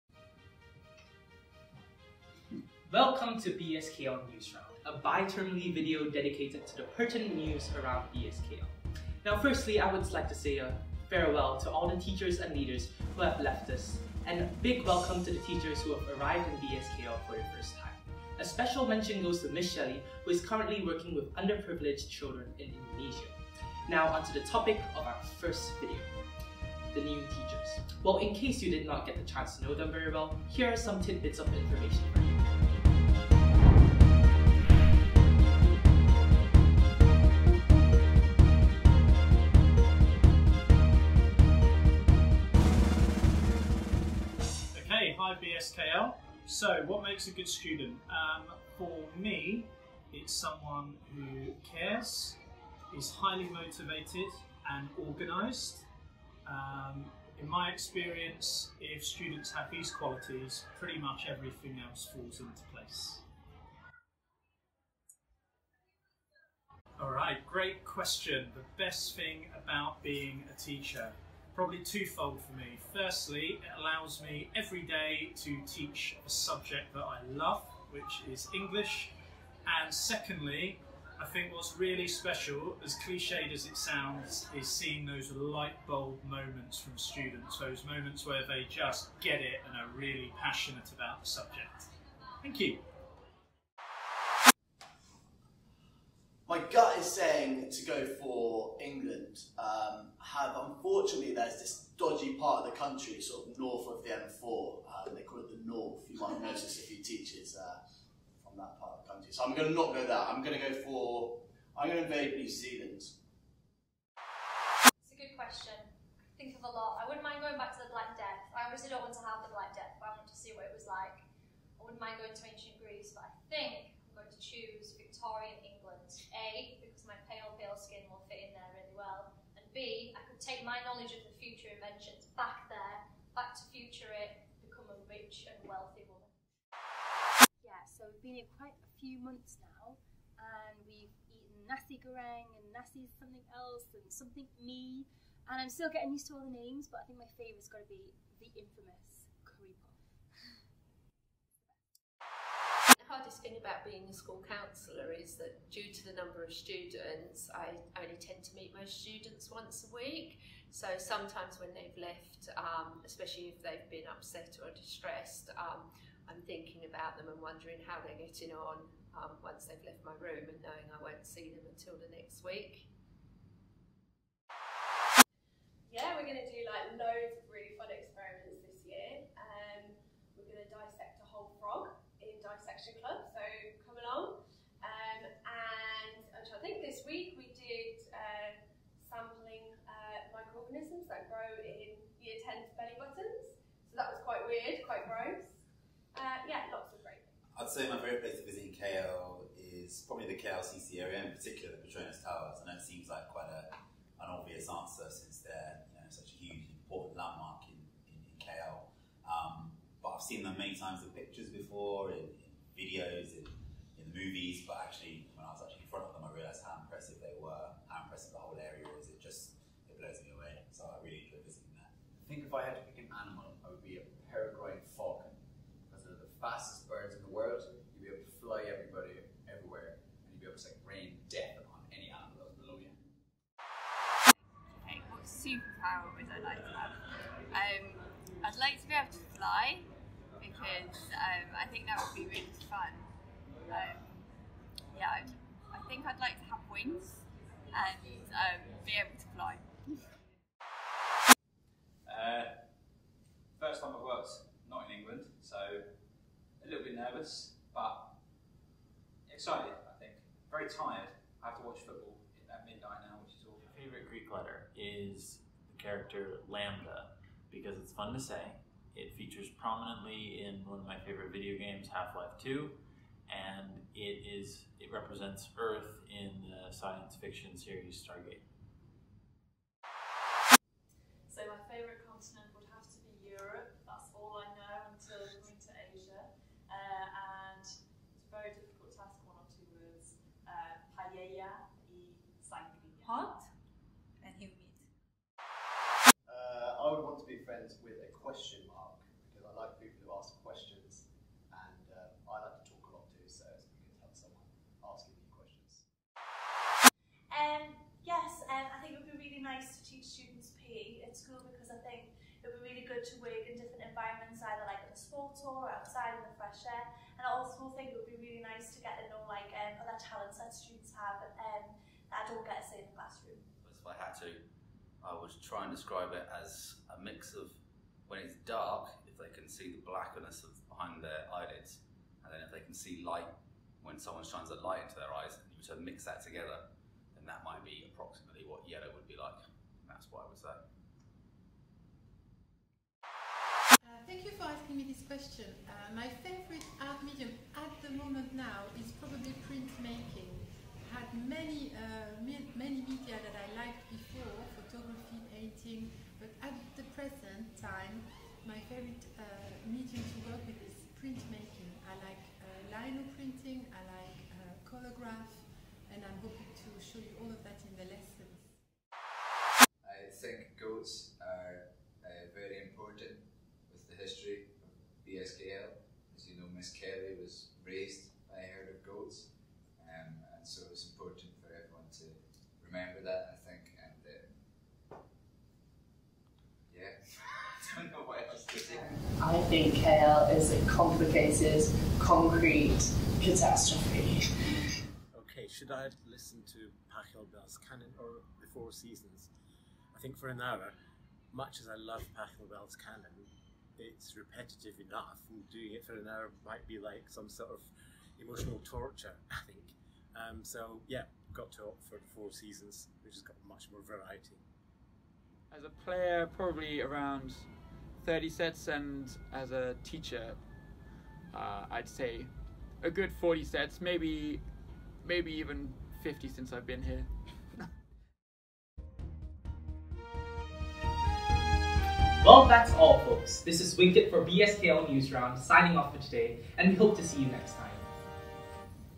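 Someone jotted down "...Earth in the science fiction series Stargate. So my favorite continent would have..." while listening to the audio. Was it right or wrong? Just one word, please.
right.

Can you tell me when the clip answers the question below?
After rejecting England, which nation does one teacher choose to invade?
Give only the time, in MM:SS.
01:52.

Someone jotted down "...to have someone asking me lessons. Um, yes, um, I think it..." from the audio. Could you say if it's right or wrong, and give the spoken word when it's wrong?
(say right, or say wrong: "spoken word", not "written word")
wrong: "questions", not "lessons".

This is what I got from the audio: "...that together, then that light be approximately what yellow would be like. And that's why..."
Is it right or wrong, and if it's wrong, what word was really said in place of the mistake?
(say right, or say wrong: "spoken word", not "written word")
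wrong: "might", not "light".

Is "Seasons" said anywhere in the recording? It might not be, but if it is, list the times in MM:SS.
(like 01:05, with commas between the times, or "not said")
06:38, 06:52.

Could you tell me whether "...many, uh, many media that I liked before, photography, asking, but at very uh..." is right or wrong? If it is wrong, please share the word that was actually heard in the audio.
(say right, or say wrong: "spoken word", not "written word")
wrong: "painting", not "asking".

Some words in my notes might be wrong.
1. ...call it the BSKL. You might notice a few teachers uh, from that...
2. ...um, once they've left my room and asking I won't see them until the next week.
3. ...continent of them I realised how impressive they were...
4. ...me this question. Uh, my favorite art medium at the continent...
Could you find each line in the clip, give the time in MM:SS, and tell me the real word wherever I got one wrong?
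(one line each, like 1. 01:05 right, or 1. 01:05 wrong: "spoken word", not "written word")
1. 01:45 wrong: "North", not "BSKL"
2. 02:49 wrong: "knowing", not "asking"
3. 03:35 wrong: "front", not "continent"
4. 05:44 wrong: "moment", not "continent".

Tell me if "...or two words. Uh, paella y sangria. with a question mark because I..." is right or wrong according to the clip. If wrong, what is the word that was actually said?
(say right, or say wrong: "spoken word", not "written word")
right.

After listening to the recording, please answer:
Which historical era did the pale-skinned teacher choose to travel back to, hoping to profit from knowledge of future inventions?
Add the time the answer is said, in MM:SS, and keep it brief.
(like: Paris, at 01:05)
Victorian England, at 02:05.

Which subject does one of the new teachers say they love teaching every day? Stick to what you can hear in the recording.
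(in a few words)
English.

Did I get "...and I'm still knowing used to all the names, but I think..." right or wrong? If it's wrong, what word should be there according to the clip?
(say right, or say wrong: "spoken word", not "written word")
wrong: "getting", not "knowing".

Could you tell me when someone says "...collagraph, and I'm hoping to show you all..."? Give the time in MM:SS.
06:04.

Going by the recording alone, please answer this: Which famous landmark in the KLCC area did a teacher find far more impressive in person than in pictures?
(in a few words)
Petronas Towers.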